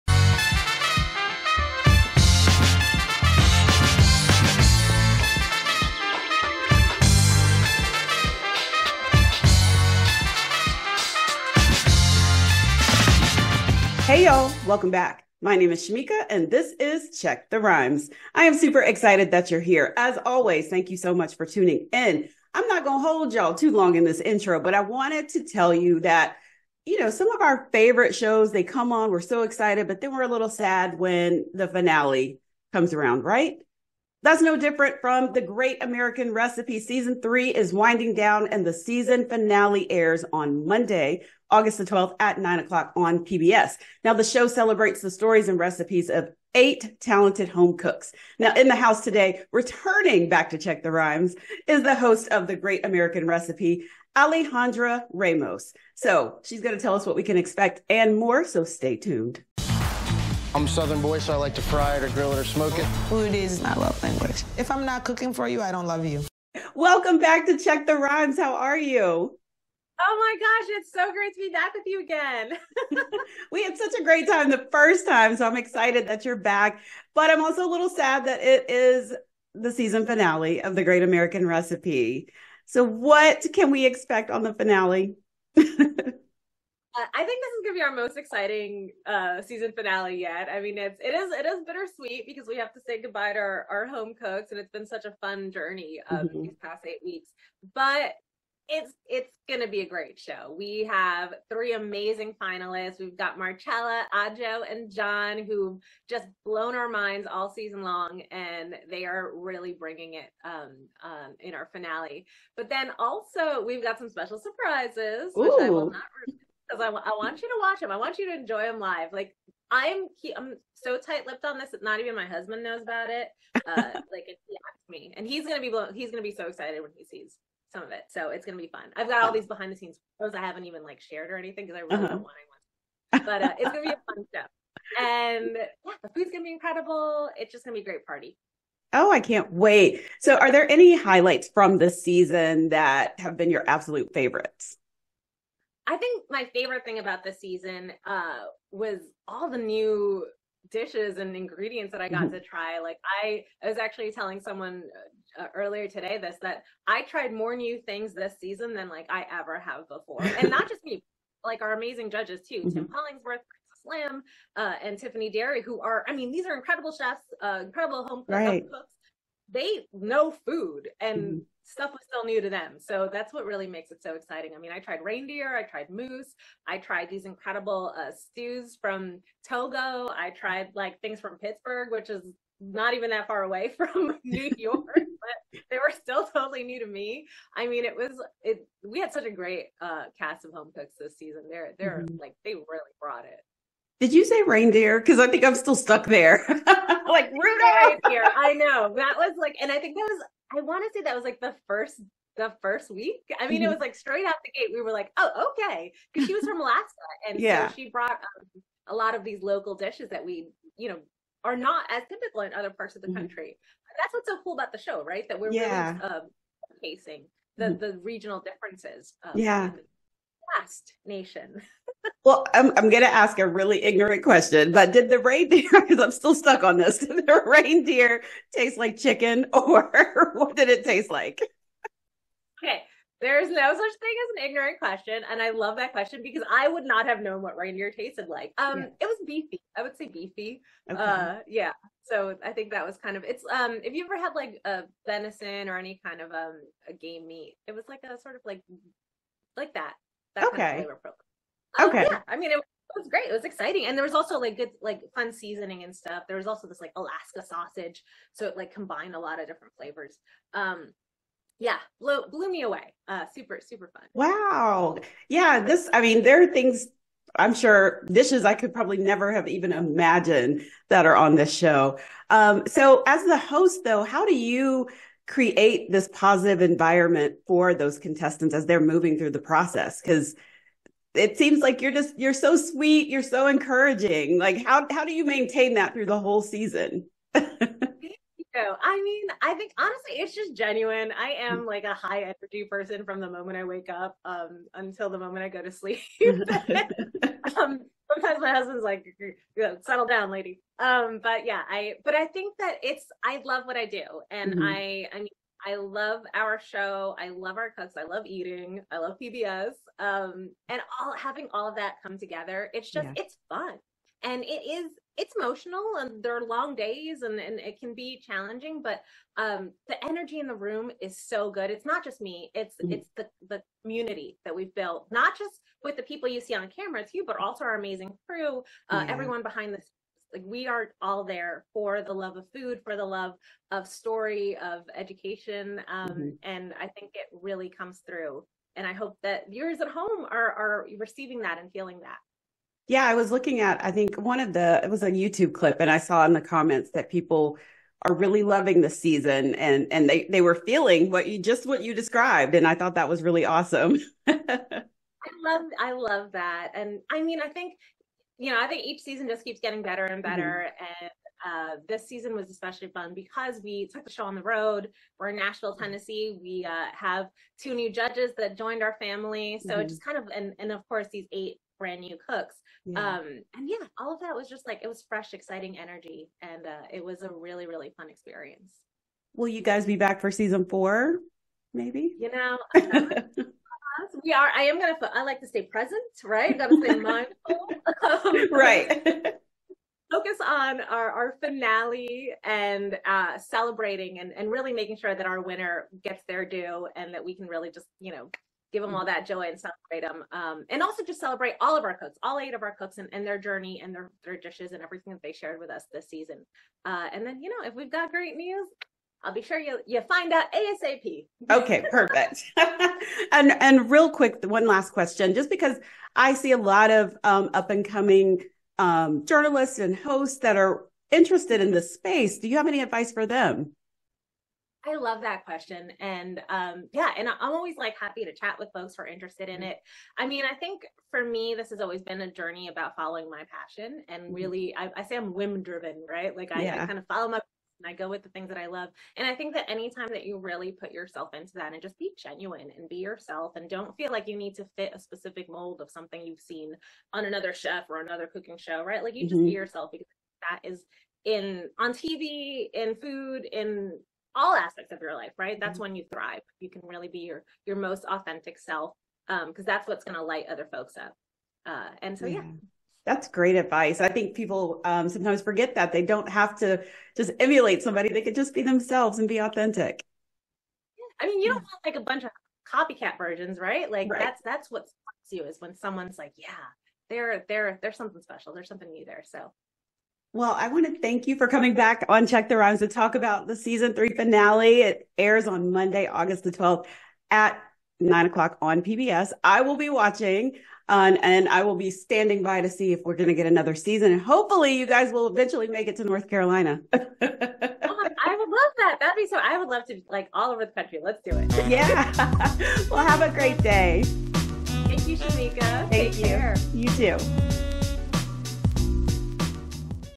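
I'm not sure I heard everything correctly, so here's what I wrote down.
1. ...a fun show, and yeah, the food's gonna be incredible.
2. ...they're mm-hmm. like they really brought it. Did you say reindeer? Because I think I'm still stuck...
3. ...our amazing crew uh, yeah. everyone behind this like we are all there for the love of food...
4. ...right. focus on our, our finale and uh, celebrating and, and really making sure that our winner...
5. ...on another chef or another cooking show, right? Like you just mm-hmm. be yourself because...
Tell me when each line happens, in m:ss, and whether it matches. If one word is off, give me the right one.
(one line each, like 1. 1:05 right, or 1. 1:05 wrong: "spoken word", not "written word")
1. 2:13 right
2. 3:11 right
3. 5:27 right
4. 6:28 right
5. 7:27 right.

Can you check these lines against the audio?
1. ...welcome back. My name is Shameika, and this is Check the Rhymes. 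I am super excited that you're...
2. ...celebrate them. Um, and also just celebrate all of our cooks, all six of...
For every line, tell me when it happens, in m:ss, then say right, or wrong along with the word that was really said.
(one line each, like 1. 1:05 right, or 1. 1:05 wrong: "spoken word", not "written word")
1. 0:14 right
2. 6:39 wrong: "eight", not "six".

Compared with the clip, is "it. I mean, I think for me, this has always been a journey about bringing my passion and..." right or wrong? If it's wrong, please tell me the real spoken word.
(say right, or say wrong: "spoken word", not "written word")
wrong: "following", not "bringing".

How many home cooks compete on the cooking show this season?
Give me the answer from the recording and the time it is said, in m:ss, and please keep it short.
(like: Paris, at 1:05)
8, at 0:46.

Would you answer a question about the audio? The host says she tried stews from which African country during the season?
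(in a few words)
Togo.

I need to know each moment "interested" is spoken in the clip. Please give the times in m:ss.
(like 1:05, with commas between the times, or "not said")
7:01, 7:09.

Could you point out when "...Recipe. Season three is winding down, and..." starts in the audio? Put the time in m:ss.
0:36.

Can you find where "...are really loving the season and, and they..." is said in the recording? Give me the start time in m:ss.
5:48.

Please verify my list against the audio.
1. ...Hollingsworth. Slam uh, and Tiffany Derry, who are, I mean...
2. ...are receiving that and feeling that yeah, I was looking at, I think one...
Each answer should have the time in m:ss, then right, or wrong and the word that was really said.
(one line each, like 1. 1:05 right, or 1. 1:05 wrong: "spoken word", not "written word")
1. 2:42 right
2. 5:40 right.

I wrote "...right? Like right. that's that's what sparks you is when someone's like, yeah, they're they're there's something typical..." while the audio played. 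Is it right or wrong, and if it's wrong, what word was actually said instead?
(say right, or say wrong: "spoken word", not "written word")
wrong: "special", not "typical".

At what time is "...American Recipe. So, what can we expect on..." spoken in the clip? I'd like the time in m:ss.
1:21.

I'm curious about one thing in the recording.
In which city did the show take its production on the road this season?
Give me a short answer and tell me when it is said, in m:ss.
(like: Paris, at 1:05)
Nashville, at 6:05.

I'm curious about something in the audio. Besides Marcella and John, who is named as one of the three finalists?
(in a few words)
Ajo.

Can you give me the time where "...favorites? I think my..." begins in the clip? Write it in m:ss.
2:24.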